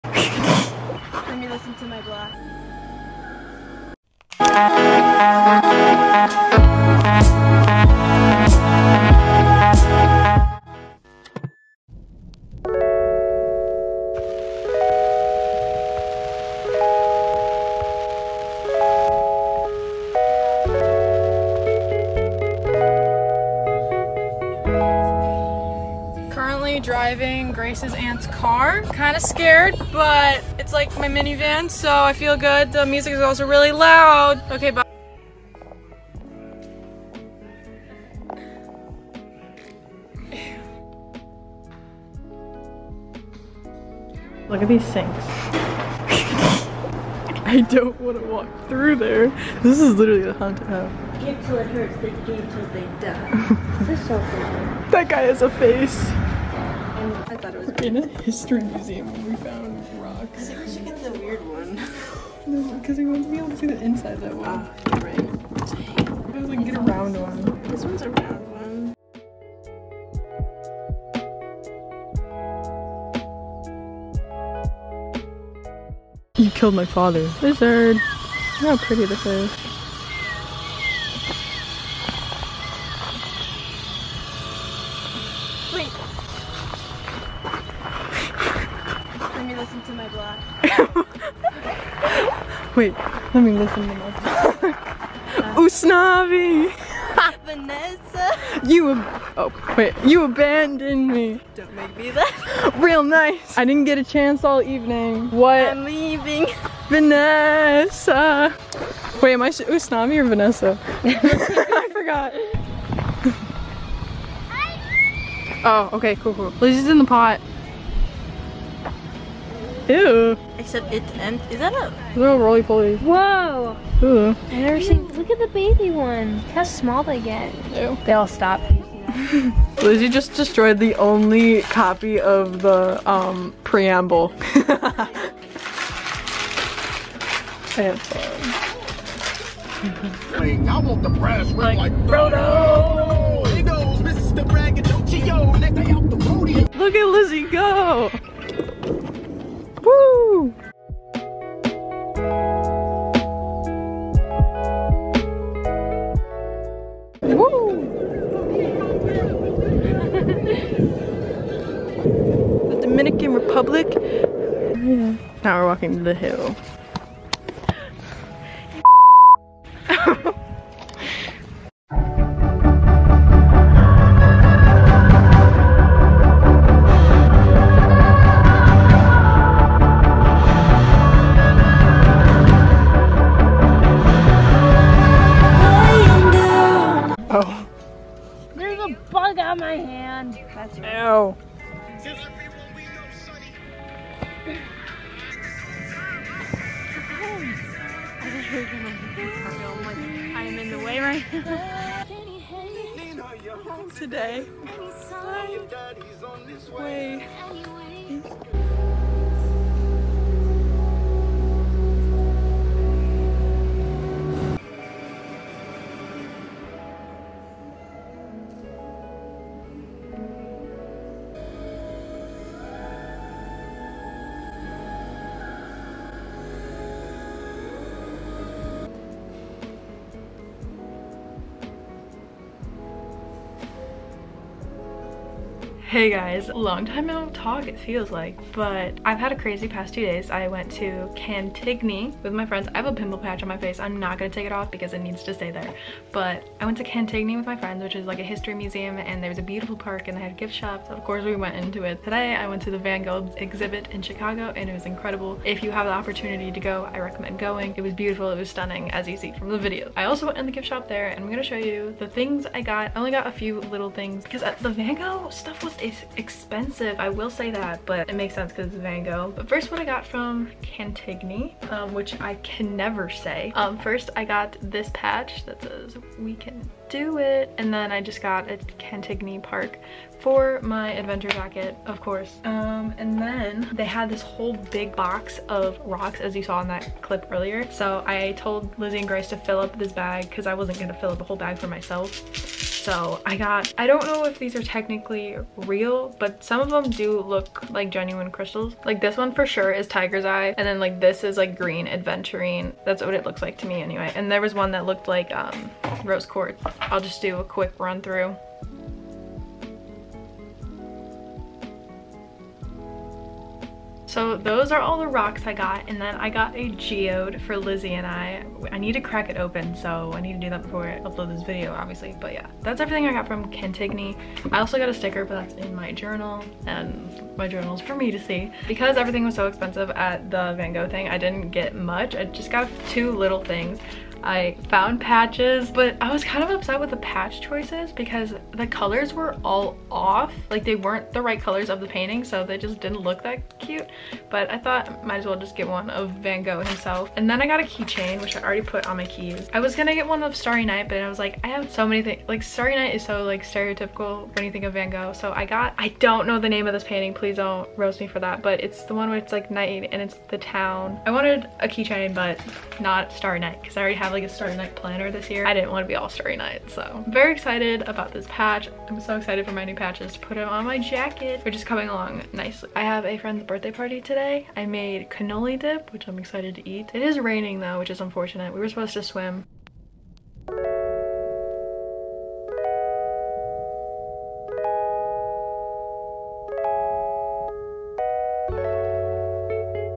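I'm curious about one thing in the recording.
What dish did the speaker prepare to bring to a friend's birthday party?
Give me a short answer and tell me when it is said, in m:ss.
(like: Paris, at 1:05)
cannoli dip, at 6:15.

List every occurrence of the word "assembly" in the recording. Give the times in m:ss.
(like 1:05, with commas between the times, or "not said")
not said.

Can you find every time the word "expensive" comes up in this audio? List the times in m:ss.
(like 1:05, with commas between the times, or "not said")
4:26, 5:29.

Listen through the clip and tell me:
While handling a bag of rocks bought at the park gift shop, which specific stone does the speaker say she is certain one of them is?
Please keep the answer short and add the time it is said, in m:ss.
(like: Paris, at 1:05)
tiger's eye, at 4:59.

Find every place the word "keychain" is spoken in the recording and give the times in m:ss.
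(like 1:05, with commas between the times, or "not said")
5:47, 6:01.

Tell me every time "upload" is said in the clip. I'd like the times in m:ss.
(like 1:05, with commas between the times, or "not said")
5:20.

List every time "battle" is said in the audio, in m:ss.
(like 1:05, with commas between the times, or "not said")
not said.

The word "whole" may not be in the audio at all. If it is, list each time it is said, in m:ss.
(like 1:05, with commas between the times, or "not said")
4:44, 4:51.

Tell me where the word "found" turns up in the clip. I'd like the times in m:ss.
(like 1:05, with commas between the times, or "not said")
0:59, 5:34.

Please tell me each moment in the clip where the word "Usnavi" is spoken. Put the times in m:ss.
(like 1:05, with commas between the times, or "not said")
1:35, 1:49.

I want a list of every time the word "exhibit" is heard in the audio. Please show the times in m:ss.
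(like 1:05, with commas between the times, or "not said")
4:13.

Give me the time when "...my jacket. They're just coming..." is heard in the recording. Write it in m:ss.
6:10.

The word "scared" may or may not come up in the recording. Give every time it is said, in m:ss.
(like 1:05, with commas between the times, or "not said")
0:29.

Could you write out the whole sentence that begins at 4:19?
I also went in the gift shop there and I'm gonna show you the things I got.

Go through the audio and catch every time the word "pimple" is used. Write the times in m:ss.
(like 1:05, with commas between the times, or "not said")
4:02.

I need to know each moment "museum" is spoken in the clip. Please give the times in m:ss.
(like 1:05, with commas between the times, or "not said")
0:58, 4:08.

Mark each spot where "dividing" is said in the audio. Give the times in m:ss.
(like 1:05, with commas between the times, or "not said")
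not said.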